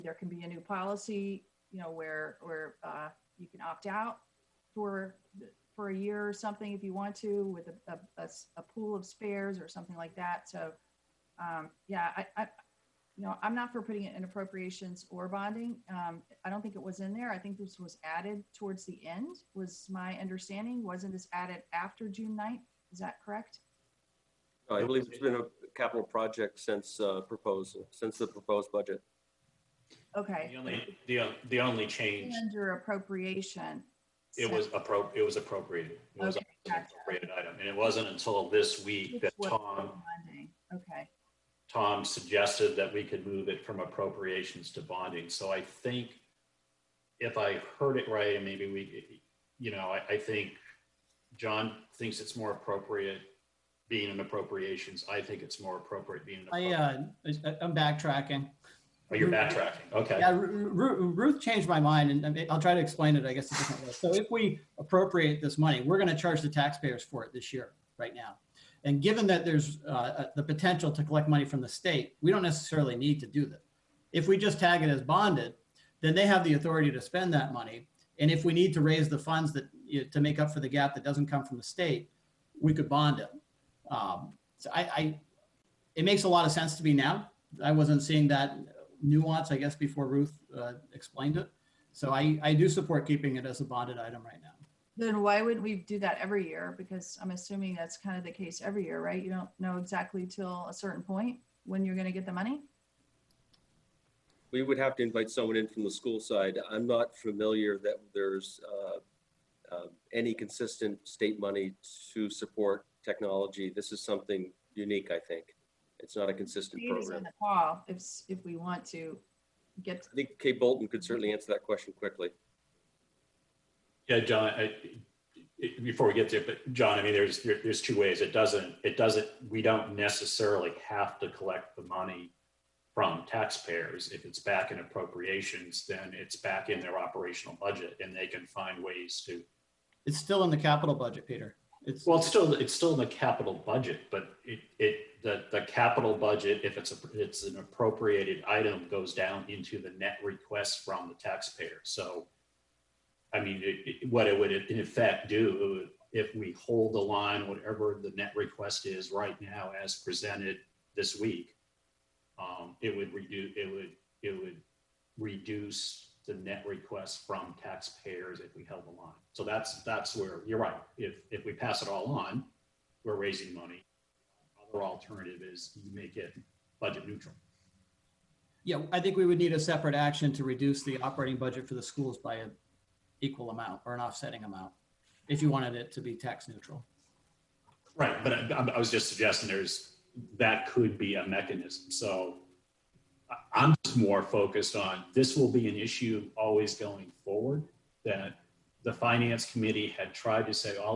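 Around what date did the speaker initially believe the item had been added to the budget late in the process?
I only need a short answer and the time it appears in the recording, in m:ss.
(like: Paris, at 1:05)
June 9th, at 0:22.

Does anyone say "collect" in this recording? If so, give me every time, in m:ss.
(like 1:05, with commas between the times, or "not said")
1:11, 2:11.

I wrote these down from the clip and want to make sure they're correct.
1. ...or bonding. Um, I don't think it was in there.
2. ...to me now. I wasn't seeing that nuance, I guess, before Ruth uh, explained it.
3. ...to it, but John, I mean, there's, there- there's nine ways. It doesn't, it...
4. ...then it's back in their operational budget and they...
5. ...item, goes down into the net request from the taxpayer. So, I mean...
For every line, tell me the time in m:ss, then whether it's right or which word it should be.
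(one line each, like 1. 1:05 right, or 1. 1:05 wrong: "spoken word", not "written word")
1. 0:15 right
2. 1:26 right
3. 2:06 wrong: "two", not "nine"
4. 2:15 right
5. 2:28 right.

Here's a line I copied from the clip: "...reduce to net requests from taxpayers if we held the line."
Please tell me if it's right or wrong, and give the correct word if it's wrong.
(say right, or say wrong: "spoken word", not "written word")
right.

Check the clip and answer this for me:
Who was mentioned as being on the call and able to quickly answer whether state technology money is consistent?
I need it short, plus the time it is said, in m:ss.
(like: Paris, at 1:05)
Kay Bolton, at 2:00.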